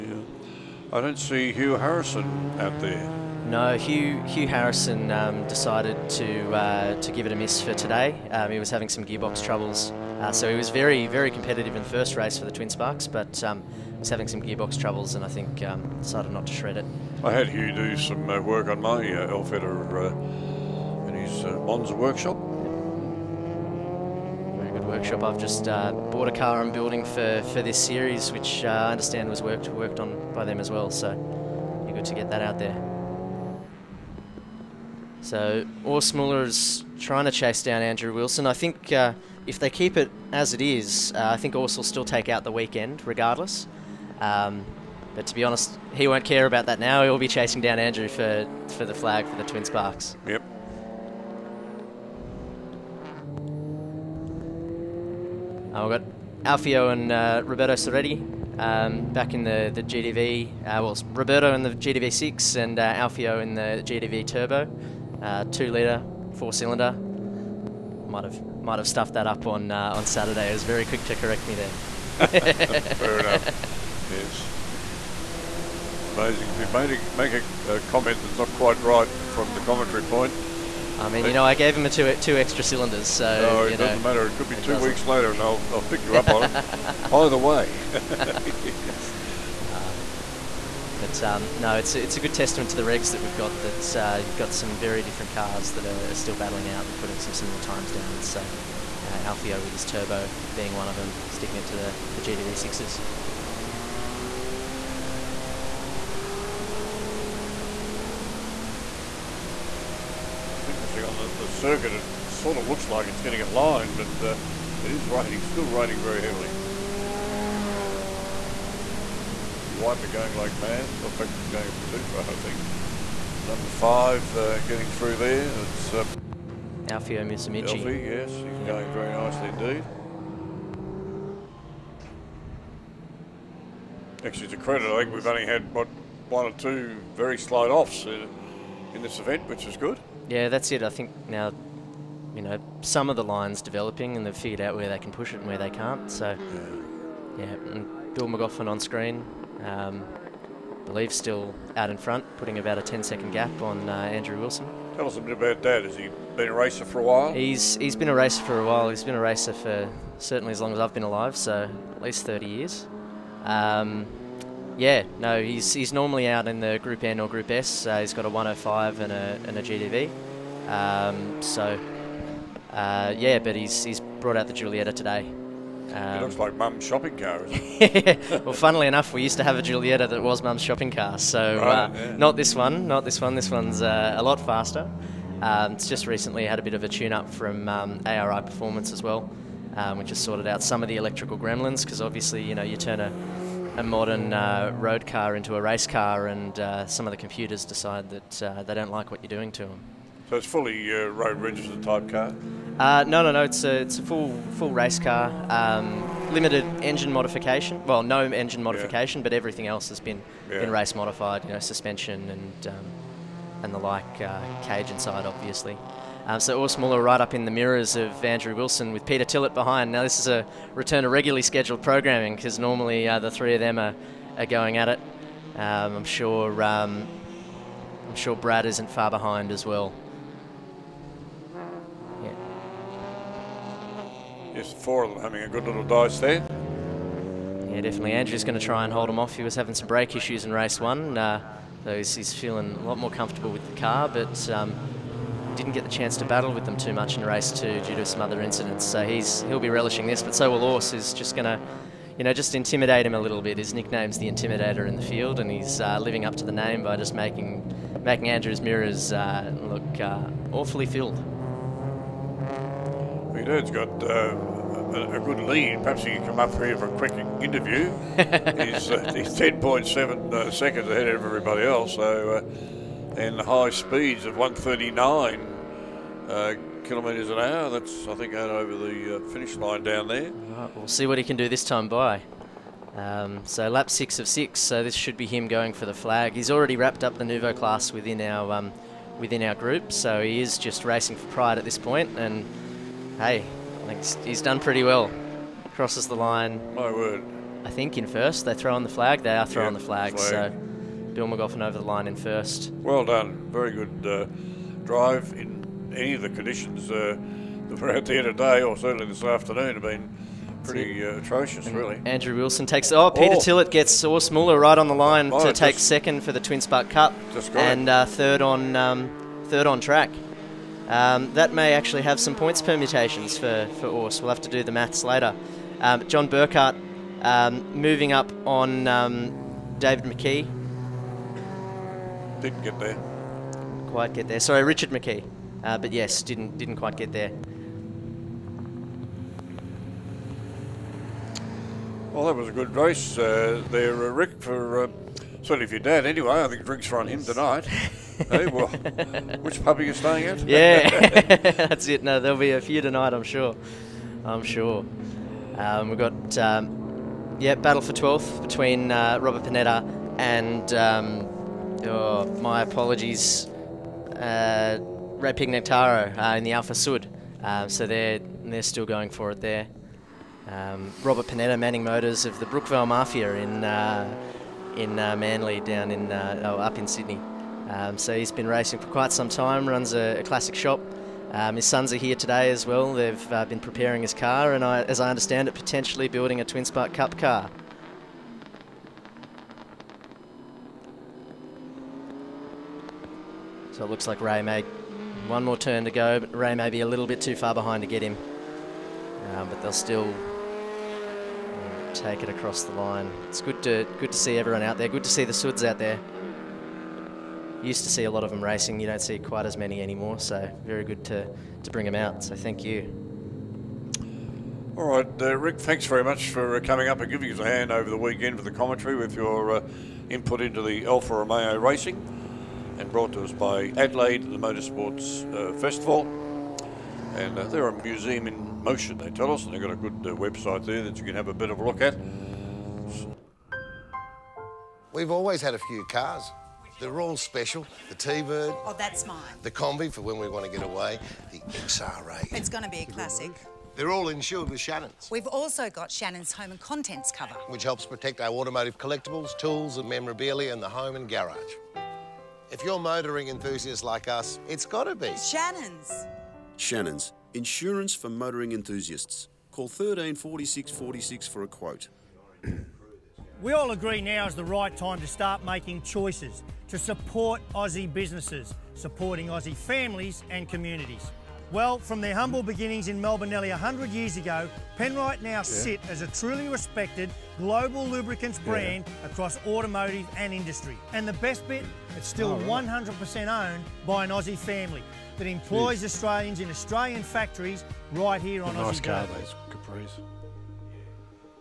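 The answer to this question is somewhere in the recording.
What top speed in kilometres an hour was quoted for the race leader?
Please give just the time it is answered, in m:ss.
4:34.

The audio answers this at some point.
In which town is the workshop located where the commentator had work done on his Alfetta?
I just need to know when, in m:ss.
0:21.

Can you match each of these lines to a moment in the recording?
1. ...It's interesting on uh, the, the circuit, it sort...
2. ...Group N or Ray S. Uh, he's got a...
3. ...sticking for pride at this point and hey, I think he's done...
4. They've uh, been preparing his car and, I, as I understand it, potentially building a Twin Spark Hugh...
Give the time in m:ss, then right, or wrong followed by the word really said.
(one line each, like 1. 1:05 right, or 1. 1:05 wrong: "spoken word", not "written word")
1. 1:50 right
2. 2:46 wrong: "Group", not "Ray"
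3. 4:50 wrong: "racing", not "sticking"
4. 6:22 wrong: "Cup", not "Hugh".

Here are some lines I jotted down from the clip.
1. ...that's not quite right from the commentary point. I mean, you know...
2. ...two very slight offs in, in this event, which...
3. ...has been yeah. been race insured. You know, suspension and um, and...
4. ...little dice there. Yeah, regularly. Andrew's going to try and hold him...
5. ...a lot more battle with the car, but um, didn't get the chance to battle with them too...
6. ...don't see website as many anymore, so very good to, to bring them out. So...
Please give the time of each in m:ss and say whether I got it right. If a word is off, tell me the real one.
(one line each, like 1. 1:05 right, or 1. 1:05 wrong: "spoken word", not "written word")
1. 1:18 right
2. 2:16 right
3. 3:29 wrong: "modified", not "insured"
4. 3:55 wrong: "definitely", not "regularly"
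5. 4:02 wrong: "comfortable", not "battle"
6. 6:48 wrong: "quite", not "website".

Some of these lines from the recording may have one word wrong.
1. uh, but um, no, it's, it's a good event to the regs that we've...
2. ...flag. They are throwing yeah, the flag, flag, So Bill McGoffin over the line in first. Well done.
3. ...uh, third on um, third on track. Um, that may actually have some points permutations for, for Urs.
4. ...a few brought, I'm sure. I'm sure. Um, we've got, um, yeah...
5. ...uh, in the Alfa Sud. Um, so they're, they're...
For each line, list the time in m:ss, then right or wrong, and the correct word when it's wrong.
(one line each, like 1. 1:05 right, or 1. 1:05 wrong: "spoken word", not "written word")
1. 1:29 wrong: "testament", not "event"
2. 4:58 right
3. 5:17 right
4. 5:52 wrong: "tonight", not "brought"
5. 6:06 right.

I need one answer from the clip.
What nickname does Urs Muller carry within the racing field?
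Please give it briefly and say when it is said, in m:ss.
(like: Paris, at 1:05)
The Intimidator, at 4:14.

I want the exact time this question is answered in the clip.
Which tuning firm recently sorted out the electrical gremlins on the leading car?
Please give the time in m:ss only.
3:08.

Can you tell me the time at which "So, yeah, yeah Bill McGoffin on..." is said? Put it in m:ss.
2:26.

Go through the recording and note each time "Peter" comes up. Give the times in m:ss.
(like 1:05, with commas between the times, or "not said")
3:39, 5:13.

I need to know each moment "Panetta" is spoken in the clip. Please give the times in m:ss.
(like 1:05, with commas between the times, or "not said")
5:59, 6:11.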